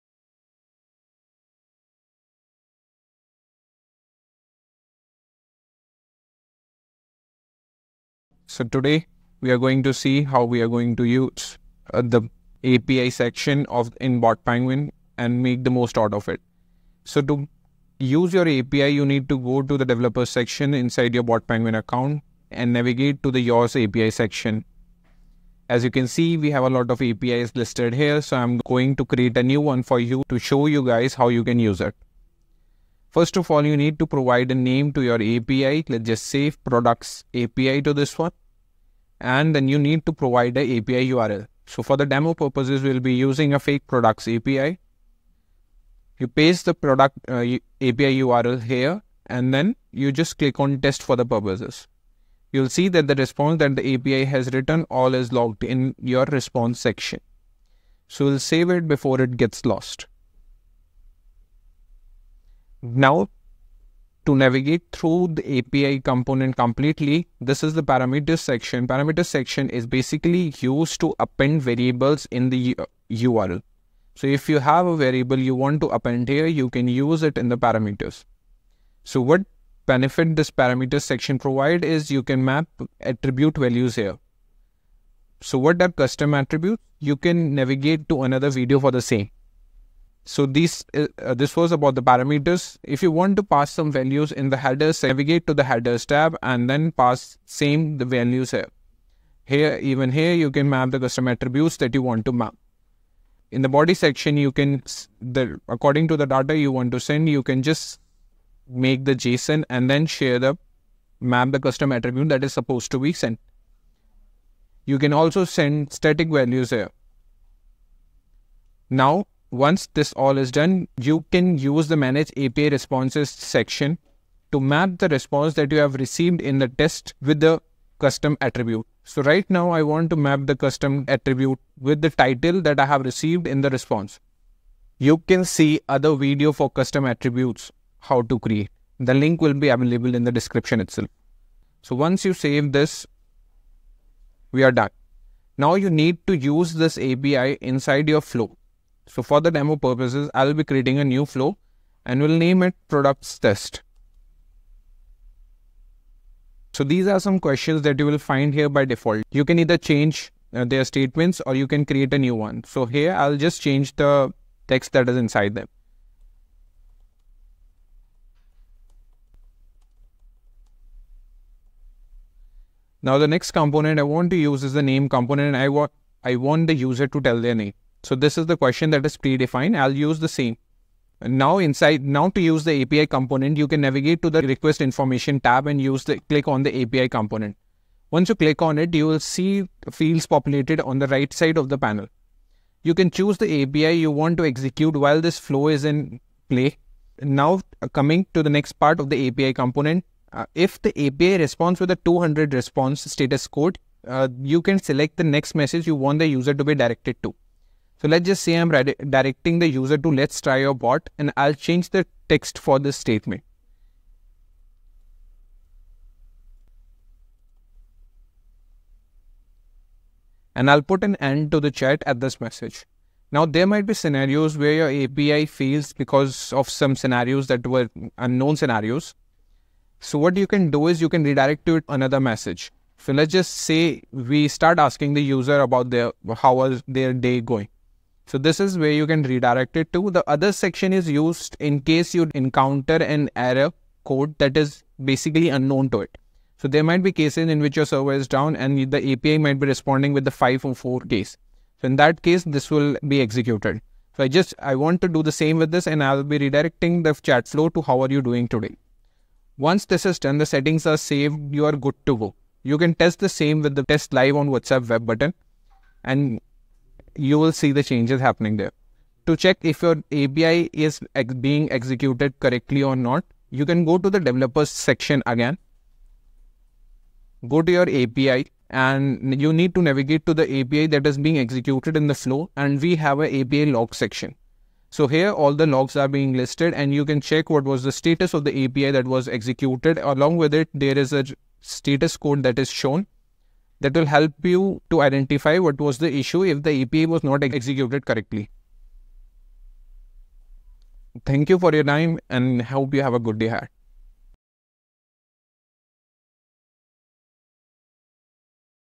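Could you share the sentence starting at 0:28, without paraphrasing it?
So I'm going to create a new one for you to show you guys how you can use it.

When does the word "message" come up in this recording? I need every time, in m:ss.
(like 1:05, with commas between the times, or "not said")
3:25, 3:42, 3:52.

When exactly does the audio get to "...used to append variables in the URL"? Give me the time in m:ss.
1:10.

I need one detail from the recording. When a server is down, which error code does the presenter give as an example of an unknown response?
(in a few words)
504.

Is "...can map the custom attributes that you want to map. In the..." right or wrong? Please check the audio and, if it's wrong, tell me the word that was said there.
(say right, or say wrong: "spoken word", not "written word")
right.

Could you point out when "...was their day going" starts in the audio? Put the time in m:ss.
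3:56.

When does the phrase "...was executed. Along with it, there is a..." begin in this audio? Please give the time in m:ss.
4:49.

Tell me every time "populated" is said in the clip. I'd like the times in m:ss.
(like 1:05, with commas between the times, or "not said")
3:10.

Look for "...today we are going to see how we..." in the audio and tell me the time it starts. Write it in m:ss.
0:08.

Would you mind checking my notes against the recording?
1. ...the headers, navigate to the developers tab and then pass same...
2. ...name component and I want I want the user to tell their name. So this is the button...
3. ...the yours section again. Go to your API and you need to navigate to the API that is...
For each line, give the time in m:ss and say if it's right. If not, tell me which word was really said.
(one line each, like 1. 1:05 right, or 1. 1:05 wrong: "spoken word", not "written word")
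1. 1:34 wrong: "headers", not "developers"
2. 2:54 wrong: "question", not "button"
3. 4:34 wrong: "developers", not "yours".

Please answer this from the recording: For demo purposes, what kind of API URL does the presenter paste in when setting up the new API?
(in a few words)
fake products API.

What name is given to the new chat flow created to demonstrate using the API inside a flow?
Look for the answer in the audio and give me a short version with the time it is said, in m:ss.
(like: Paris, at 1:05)
products test, at 2:32.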